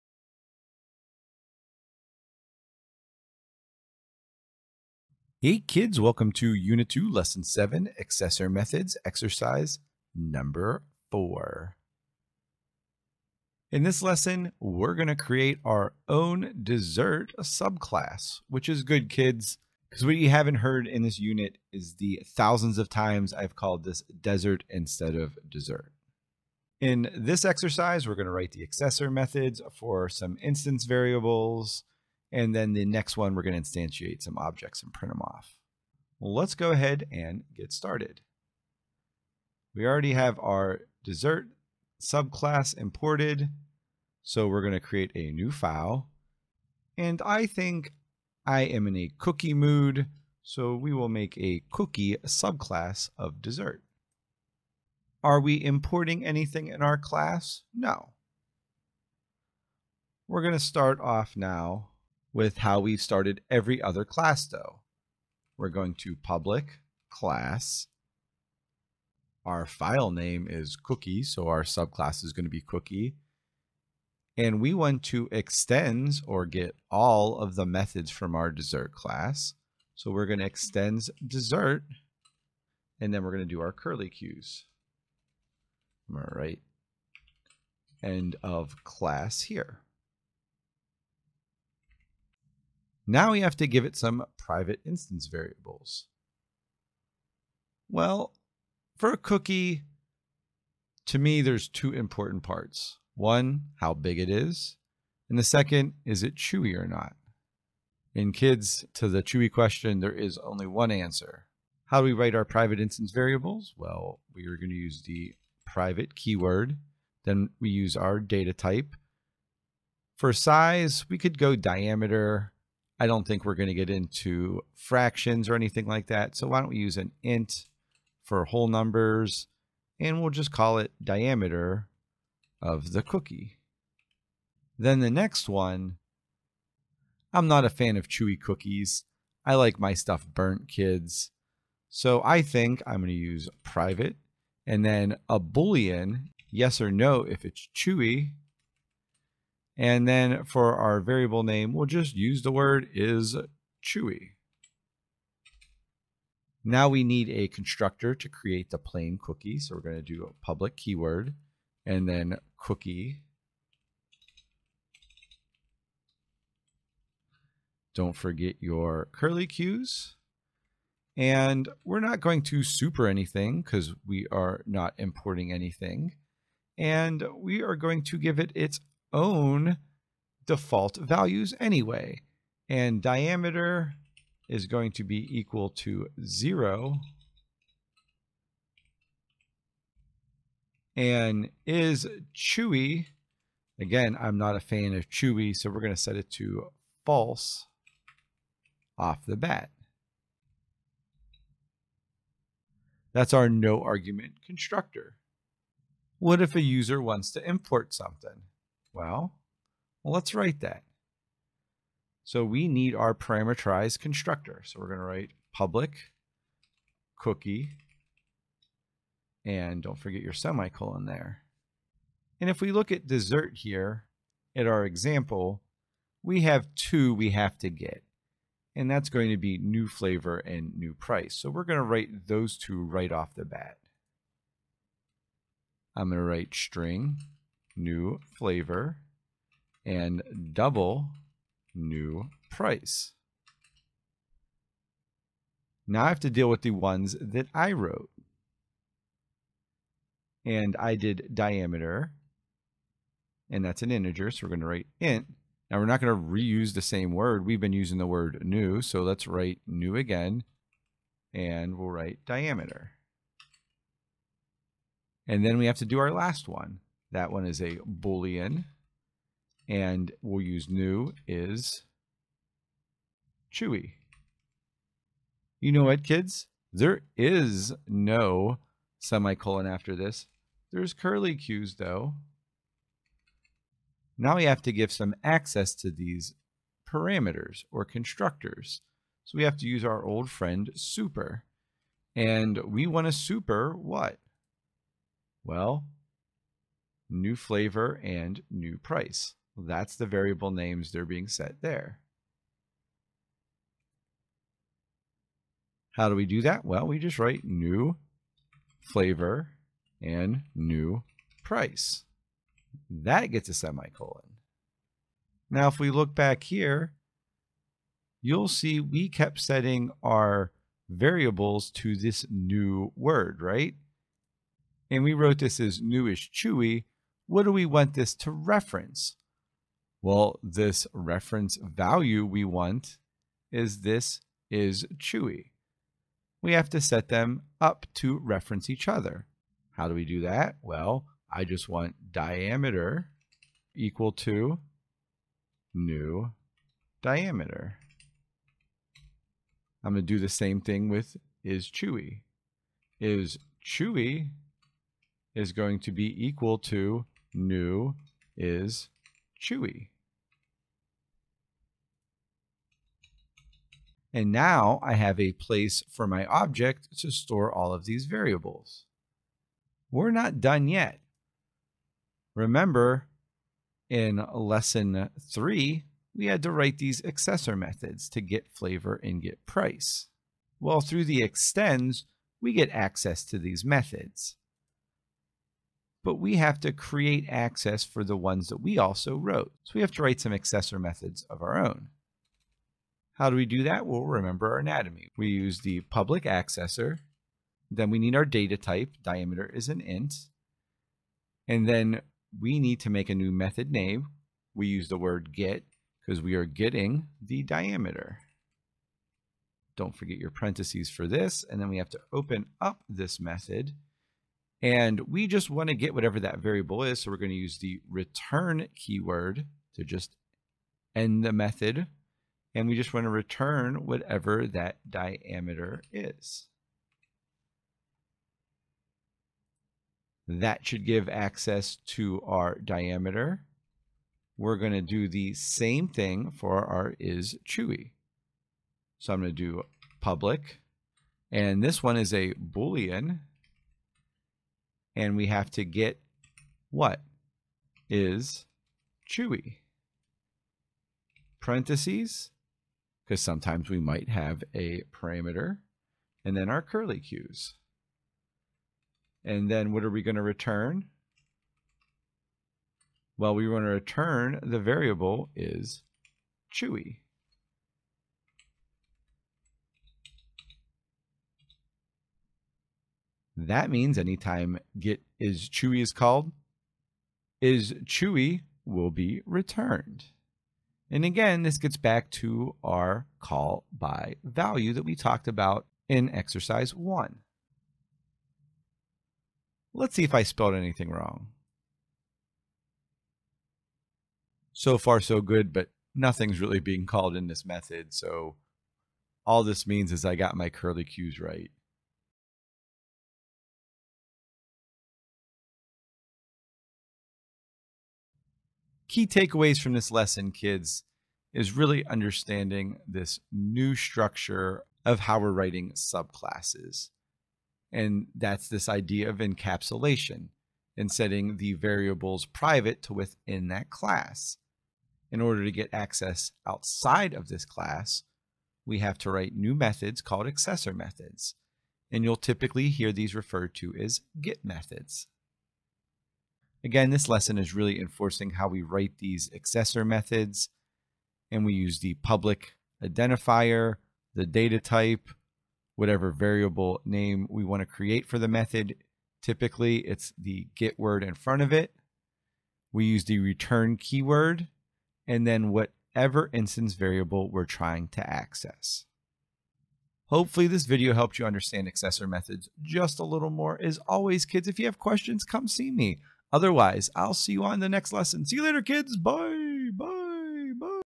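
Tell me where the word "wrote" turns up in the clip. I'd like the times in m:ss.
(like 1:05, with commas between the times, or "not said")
4:07, 5:25, 6:29.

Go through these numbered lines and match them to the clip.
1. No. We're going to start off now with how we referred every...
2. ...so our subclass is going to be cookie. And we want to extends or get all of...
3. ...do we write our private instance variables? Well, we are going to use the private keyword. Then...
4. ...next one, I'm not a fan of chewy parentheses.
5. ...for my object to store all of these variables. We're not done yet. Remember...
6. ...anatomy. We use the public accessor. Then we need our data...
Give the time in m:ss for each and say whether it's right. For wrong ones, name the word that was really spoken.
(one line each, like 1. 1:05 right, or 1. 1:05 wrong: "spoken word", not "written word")
1. 0:57 wrong: "started", not "referred"
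2. 1:11 right
3. 1:51 right
4. 2:15 wrong: "cookies", not "parentheses"
5. 6:05 right
6. 6:34 right.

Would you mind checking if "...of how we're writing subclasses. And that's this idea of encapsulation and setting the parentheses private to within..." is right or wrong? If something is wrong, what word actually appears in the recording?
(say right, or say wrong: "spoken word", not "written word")
wrong: "variables", not "parentheses".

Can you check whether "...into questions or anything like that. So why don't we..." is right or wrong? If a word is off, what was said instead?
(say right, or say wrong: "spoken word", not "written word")
wrong: "fractions", not "questions".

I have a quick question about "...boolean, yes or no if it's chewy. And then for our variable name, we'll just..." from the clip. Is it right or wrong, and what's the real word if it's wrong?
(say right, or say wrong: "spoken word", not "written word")
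right.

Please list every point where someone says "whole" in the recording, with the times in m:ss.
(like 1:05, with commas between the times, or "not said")
2:08.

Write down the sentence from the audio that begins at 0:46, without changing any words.
And I think I am in a cookie mood.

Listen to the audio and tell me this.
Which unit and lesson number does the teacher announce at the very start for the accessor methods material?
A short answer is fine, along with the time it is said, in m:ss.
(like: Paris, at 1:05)
Unit 2, Lesson 7, at 0:06.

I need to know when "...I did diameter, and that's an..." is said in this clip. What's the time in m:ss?
4:10.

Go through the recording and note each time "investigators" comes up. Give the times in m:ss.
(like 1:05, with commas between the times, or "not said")
not said.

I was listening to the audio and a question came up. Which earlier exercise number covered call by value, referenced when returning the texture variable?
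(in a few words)
1.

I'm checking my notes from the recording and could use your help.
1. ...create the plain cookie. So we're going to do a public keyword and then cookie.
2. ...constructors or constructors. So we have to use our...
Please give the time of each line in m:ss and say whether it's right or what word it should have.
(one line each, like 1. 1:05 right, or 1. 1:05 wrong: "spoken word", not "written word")
1. 2:38 right
2. 4:46 wrong: "parameters", not "constructors".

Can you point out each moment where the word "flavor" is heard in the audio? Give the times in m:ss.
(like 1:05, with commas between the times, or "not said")
3:49, 3:58, 4:57, 5:08, 6:18.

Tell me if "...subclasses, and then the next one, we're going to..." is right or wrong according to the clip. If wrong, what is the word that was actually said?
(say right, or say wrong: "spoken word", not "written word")
wrong: "variables", not "subclasses".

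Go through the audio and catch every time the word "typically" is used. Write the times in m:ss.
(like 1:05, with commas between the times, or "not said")
8:52, 9:09.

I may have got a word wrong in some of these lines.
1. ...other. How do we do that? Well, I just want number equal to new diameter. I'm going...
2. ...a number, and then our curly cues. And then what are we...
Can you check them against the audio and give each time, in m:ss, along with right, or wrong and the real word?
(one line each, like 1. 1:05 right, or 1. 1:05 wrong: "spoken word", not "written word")
1. 5:38 wrong: "diameter", not "number"
2. 7:34 wrong: "parameter", not "number".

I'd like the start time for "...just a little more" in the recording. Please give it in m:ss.
9:22.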